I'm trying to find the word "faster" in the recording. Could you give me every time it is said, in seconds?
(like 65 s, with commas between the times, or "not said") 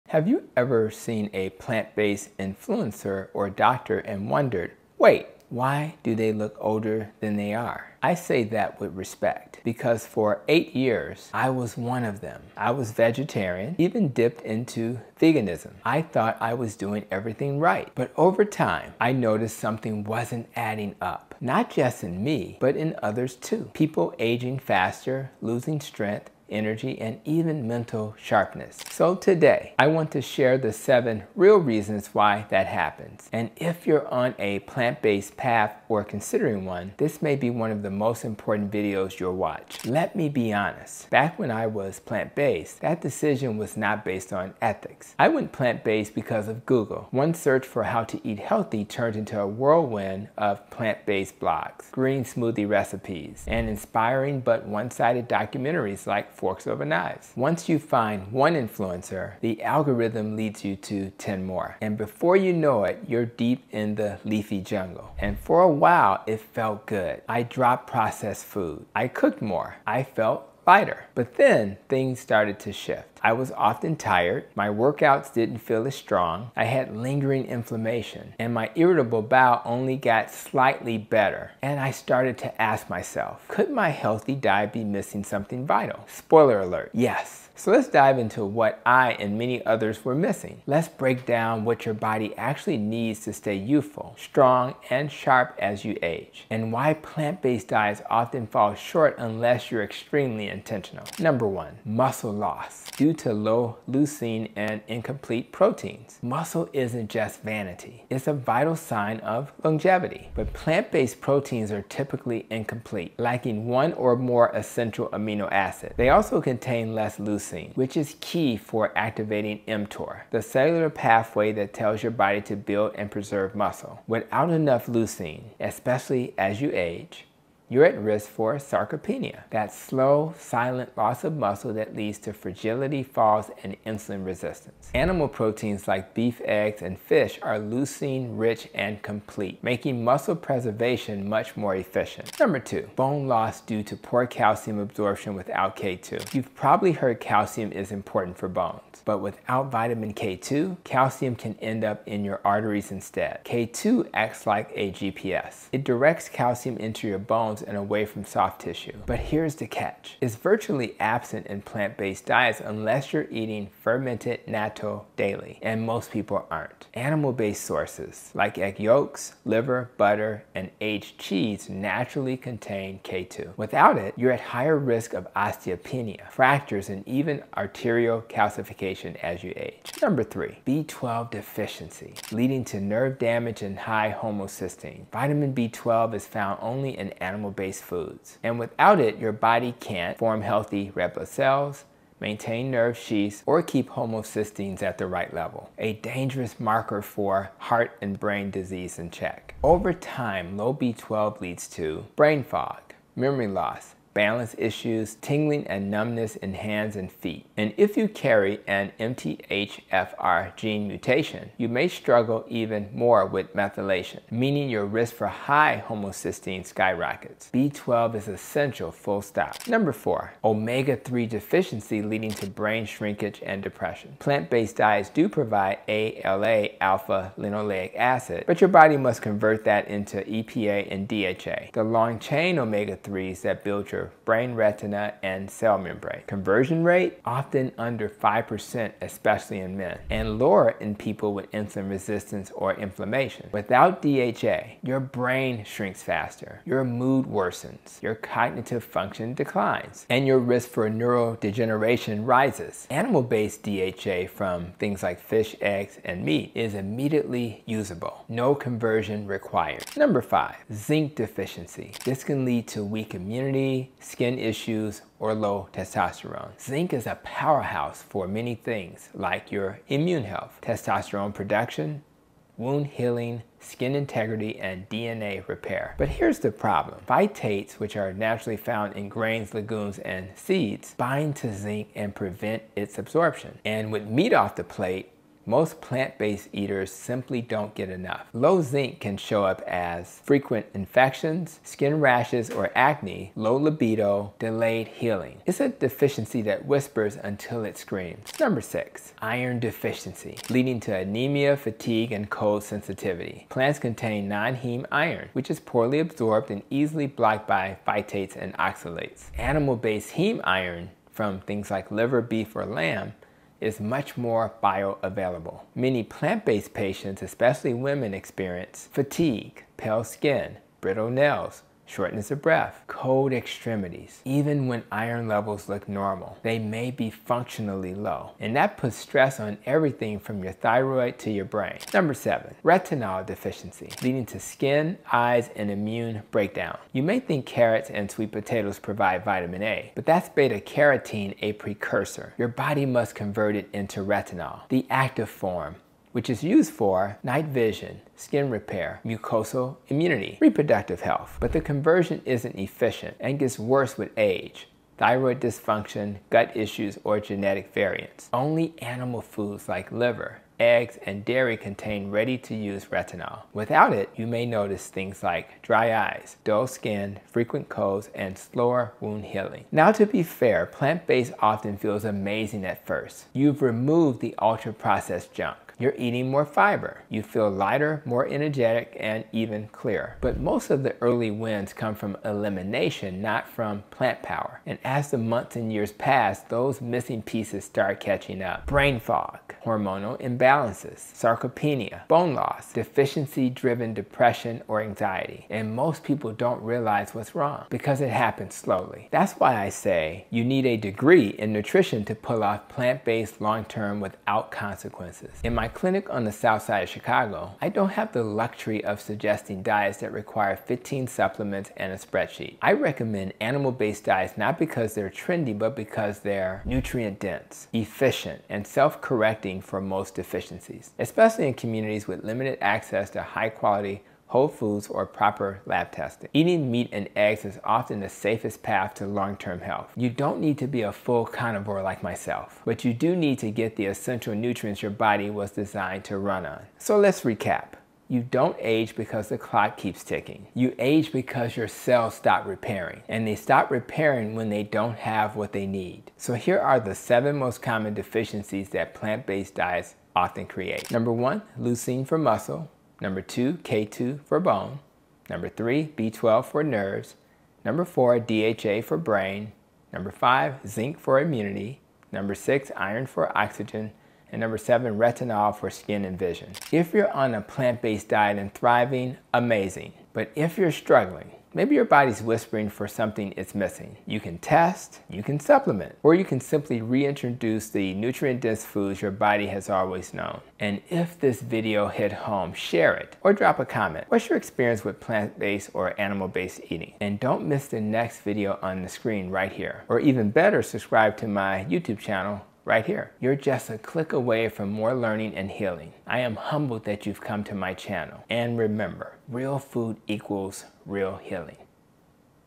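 24 s, 246 s.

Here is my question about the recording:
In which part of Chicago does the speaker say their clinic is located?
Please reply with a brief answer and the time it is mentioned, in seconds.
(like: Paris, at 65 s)
south side, at 406 s.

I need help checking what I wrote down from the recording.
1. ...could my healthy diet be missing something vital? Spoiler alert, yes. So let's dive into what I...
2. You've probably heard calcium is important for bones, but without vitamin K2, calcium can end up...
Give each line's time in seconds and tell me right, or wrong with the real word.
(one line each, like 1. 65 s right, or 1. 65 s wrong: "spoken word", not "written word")
1. 83 s right
2. 146 s right.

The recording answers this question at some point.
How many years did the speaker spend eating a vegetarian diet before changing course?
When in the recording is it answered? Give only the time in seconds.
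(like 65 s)
10 s.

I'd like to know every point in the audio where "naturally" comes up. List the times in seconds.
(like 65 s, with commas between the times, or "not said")
171 s, 278 s.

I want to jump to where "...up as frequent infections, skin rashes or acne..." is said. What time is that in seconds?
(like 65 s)
289 s.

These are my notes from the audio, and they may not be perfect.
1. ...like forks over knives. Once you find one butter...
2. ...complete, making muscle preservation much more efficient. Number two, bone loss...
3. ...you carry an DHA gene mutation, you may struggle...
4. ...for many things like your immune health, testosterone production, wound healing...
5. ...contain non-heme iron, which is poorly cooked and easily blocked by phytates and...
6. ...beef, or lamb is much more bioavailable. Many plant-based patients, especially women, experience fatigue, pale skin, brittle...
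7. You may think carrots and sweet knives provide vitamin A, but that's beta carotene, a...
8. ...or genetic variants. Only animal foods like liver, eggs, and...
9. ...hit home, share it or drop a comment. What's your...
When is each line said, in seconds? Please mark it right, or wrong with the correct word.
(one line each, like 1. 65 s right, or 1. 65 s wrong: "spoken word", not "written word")
1. 56 s wrong: "influencer", not "butter"
2. 139 s right
3. 207 s wrong: "MTHFR", not "DHA"
4. 268 s right
5. 303 s wrong: "absorbed", not "cooked"
6. 312 s right
7. 336 s wrong: "potatoes", not "knives"
8. 357 s right
9. 481 s right.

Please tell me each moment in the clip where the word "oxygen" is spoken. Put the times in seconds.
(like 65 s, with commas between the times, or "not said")
463 s.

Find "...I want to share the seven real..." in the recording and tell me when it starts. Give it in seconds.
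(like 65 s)
29 s.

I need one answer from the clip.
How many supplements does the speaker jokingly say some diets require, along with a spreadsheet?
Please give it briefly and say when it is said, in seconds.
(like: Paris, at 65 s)
15, at 410 s.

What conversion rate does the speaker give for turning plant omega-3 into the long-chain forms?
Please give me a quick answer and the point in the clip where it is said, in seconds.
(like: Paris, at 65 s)
under 5%, at 237 s.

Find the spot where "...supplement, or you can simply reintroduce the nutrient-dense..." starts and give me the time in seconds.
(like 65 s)
475 s.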